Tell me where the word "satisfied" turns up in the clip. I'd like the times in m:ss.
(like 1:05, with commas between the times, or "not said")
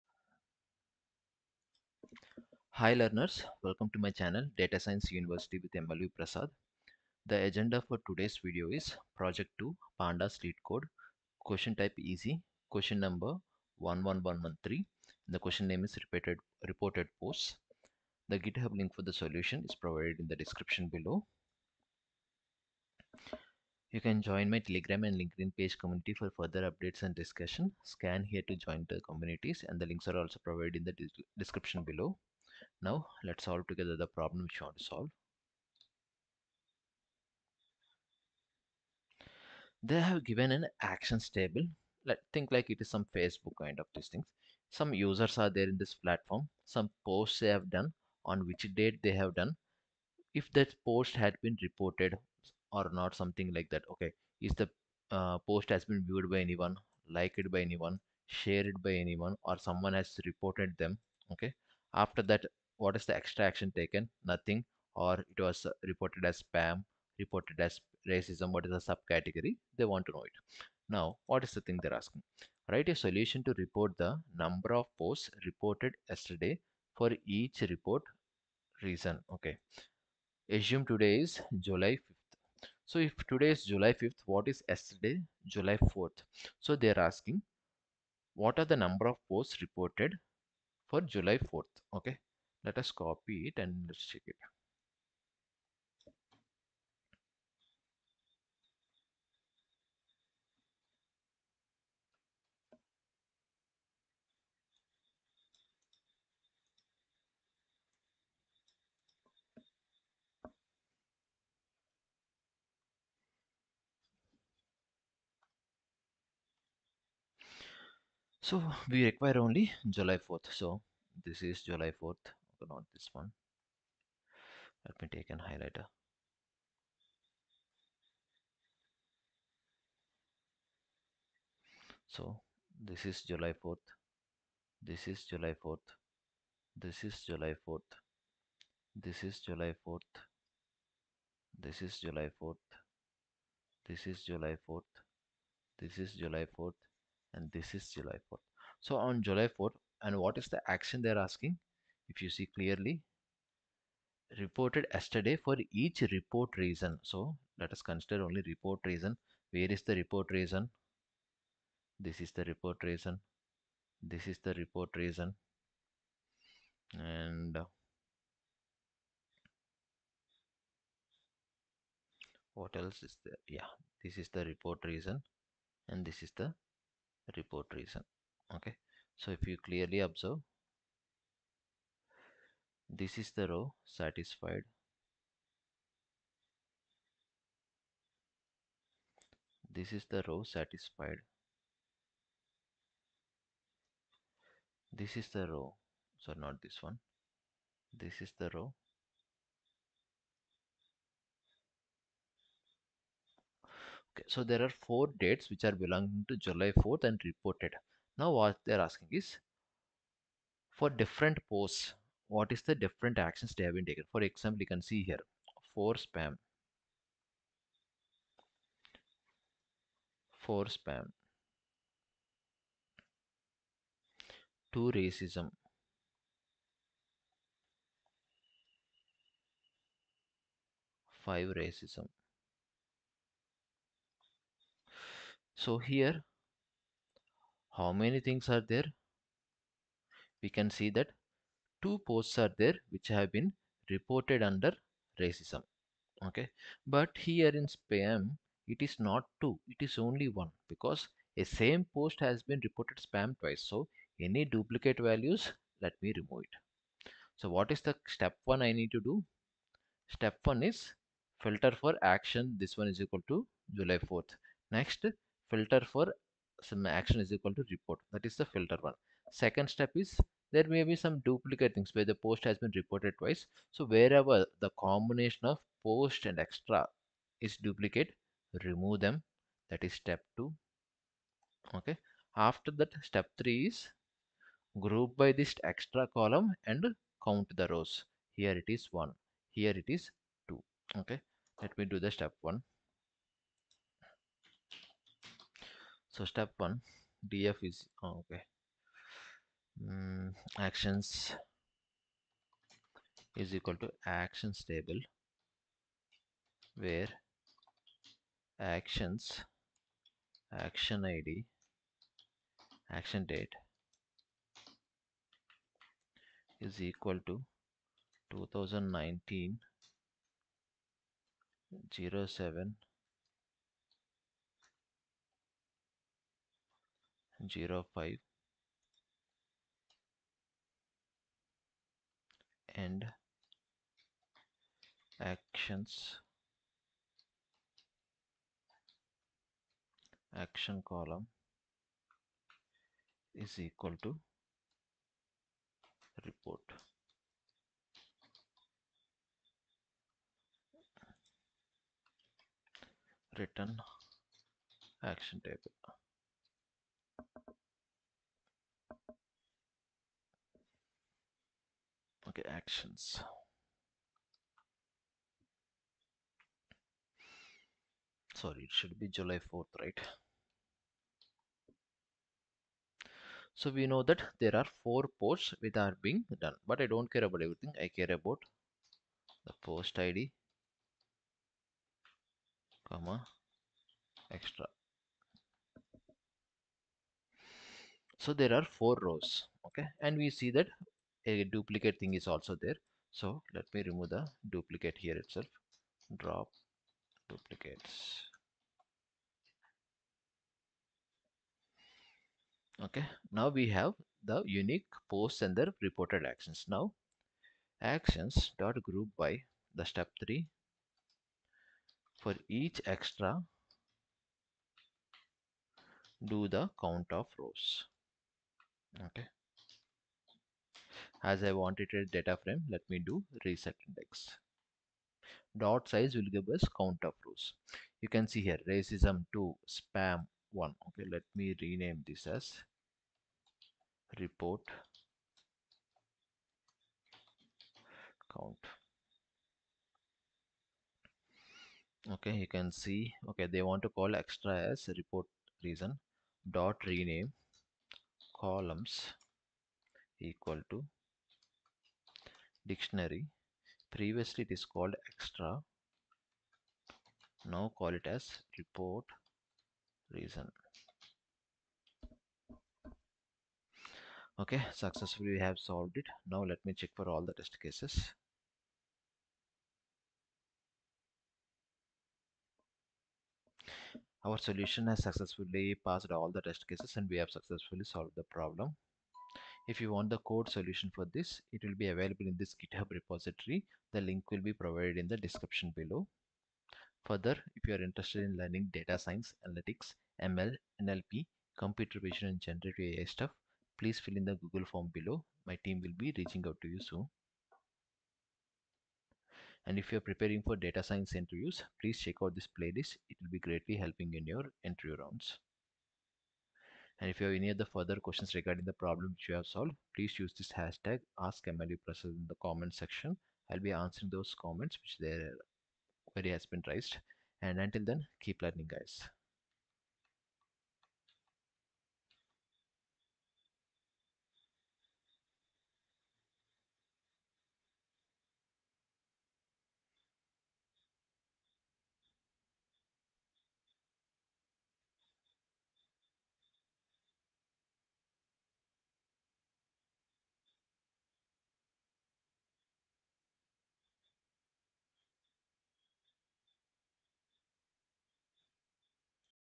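3:03, 3:10.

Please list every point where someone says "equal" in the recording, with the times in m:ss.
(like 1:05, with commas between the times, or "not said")
4:23, 4:27, 5:03, 5:16, 5:43, 7:30.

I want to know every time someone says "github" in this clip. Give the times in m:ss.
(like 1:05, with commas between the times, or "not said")
0:18, 8:02.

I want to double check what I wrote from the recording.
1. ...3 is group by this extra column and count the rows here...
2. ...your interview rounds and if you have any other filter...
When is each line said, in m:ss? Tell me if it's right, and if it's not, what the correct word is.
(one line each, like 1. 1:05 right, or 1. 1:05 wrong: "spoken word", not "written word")
1. 4:43 right
2. 8:24 wrong: "further", not "filter".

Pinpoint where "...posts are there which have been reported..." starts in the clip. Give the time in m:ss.
4:02.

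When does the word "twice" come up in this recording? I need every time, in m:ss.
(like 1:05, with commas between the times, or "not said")
4:13, 4:33.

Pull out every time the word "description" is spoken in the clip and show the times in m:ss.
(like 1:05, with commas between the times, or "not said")
0:20, 0:31, 8:05.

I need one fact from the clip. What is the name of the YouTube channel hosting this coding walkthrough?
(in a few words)
Data Science University.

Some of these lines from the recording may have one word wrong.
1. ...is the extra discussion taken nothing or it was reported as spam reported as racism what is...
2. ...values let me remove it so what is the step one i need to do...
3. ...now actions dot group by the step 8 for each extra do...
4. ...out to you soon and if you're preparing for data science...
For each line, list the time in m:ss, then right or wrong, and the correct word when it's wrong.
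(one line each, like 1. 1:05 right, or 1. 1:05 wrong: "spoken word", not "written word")
1. 1:02 wrong: "action", not "discussion"
2. 4:15 right
3. 6:46 wrong: "3", not "8"
4. 8:16 right.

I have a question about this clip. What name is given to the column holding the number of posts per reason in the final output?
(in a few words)
report count.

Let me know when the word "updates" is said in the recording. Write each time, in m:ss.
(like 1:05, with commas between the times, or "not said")
0:26.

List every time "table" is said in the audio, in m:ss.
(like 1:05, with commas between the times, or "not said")
0:41, 5:04, 5:55.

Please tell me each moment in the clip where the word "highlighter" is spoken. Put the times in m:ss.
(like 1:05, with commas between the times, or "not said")
2:05.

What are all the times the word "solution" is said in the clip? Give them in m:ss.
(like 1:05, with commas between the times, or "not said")
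0:19, 1:12, 7:54, 8:00.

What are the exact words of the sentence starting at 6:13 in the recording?
So we know that there are four posts which are being done, but I don't care about everything.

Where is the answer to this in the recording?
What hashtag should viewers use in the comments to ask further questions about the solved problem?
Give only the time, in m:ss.
8:31.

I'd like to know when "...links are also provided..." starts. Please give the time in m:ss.
0:29.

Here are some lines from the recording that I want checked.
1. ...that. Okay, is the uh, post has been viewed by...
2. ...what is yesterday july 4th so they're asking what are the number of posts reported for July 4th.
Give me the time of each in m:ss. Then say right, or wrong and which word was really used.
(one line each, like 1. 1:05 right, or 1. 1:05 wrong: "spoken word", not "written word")
1. 0:53 right
2. 1:24 right.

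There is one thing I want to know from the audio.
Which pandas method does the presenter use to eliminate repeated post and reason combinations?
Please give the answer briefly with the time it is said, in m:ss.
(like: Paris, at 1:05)
drop duplicates, at 6:36.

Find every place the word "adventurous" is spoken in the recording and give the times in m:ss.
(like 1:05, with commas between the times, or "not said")
not said.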